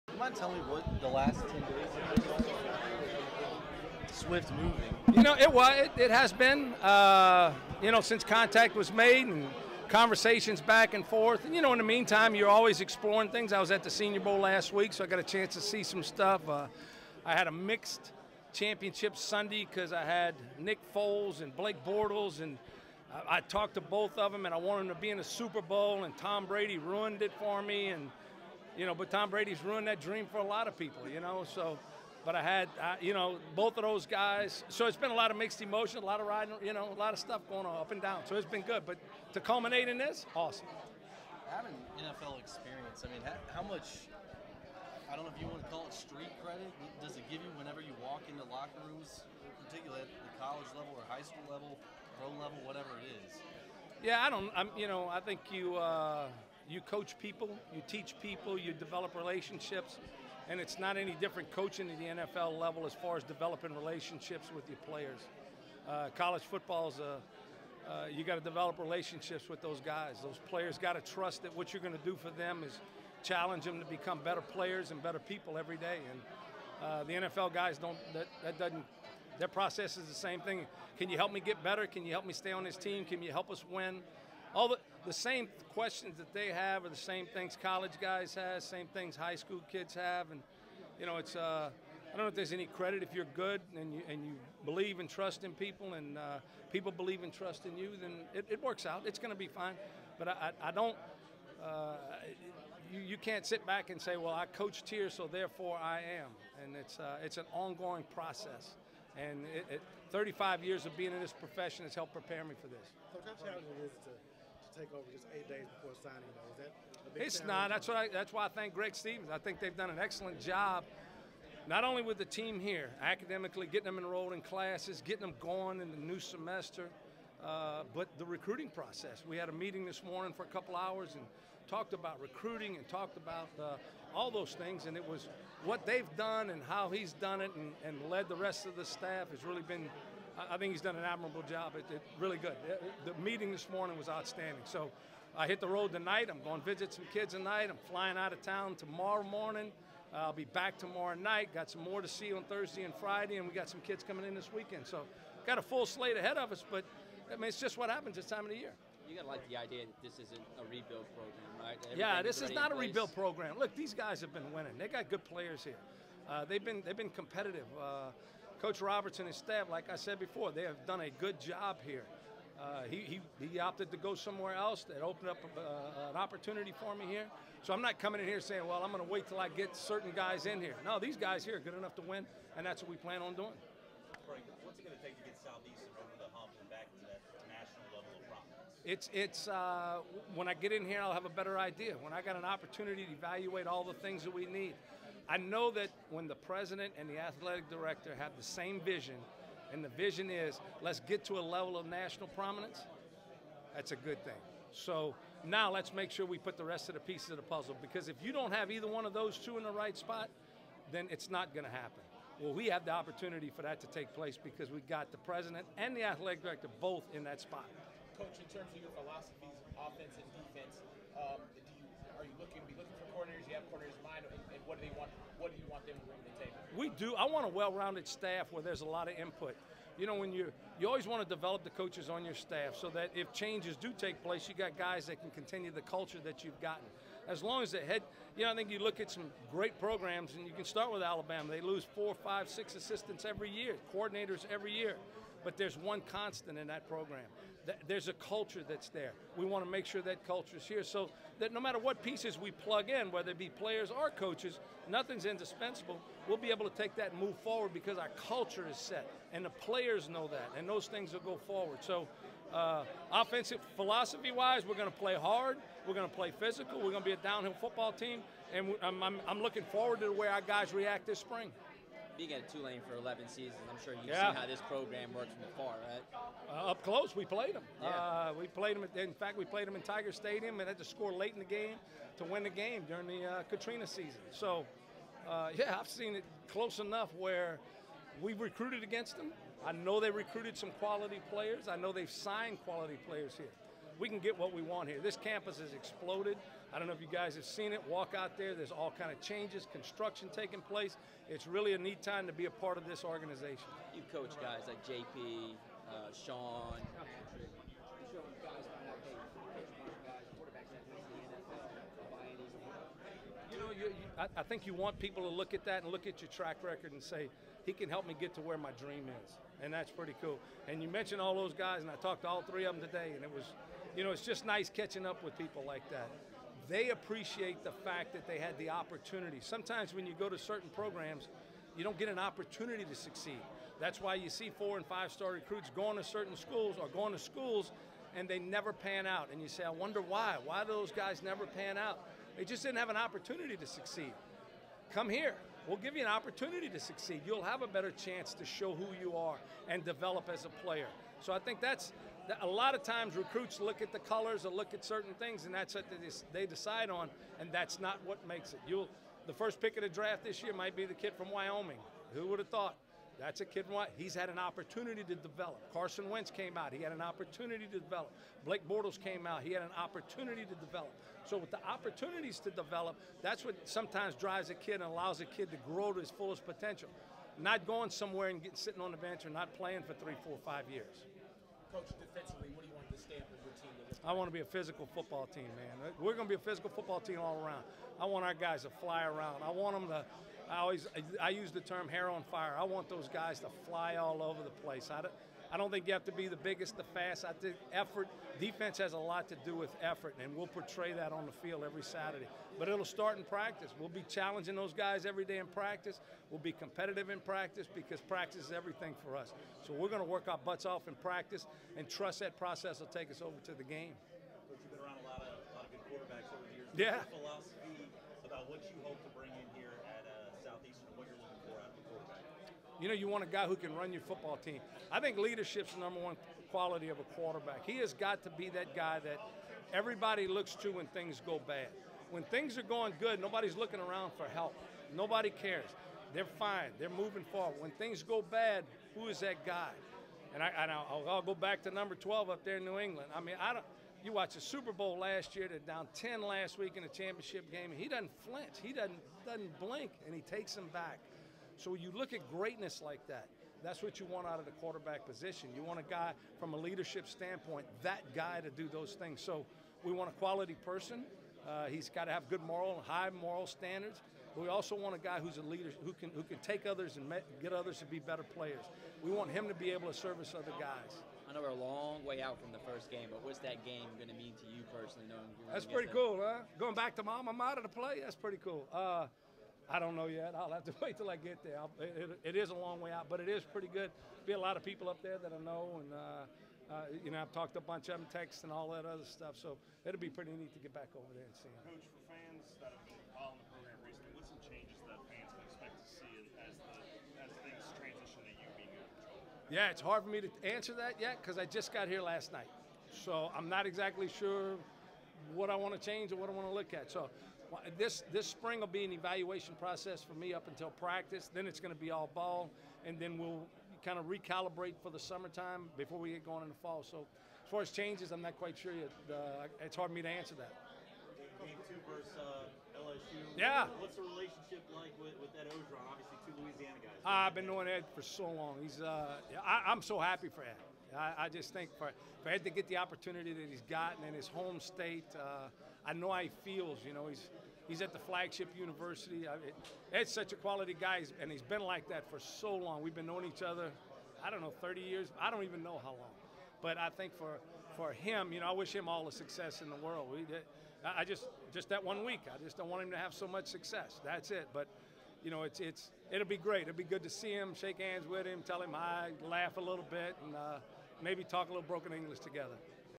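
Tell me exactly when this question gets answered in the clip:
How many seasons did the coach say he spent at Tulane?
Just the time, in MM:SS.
04:32.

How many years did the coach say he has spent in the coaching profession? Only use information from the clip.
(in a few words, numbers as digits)
35.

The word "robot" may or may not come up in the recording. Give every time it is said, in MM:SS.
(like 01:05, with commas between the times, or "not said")
not said.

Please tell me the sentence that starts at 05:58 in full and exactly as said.
You'll the first pick of the draft this year might be the kid from Wyoming.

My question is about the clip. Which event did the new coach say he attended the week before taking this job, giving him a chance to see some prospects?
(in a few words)
Senior Bowl.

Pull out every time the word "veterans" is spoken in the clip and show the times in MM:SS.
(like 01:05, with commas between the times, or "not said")
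not said.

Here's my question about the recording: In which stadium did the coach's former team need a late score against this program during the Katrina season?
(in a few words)
Tiger Stadium.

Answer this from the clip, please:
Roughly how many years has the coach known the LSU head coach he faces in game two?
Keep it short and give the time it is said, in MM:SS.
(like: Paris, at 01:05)
30, at 09:04.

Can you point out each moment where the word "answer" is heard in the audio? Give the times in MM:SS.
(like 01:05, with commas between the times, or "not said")
08:20, 08:40.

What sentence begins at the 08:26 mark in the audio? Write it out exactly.
So this this spring will be an evaluation process for me up until practice.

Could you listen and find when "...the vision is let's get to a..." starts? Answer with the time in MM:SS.
03:19.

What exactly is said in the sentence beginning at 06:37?
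I think effort, defense has a lot to do with effort, and we'll portray that on the field every Saturday.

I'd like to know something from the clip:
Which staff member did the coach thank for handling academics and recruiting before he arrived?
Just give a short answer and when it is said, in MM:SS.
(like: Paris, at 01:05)
Greg Stevens, at 01:58.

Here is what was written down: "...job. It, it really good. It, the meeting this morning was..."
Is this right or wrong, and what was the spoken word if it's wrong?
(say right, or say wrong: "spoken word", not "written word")
right.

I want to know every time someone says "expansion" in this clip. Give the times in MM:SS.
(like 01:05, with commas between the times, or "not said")
not said.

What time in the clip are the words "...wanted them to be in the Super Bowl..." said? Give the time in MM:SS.
00:24.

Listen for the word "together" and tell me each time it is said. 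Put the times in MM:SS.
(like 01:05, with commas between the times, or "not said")
09:22.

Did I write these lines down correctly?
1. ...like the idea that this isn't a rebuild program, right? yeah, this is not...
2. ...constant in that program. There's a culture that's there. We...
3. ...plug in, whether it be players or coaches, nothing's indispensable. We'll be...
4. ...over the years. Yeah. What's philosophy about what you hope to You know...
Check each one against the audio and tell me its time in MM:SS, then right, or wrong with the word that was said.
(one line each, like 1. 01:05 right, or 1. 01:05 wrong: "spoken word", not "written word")
1. 02:39 right
2. 04:06 right
3. 04:12 right
4. 06:56 right.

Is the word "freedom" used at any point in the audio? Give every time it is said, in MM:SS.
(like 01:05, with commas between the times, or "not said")
not said.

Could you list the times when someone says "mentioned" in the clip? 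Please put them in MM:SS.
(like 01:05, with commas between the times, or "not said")
05:20.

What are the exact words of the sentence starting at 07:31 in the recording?
So you look at greatness like that.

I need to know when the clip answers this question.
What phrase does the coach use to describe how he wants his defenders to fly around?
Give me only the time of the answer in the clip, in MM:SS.
06:31.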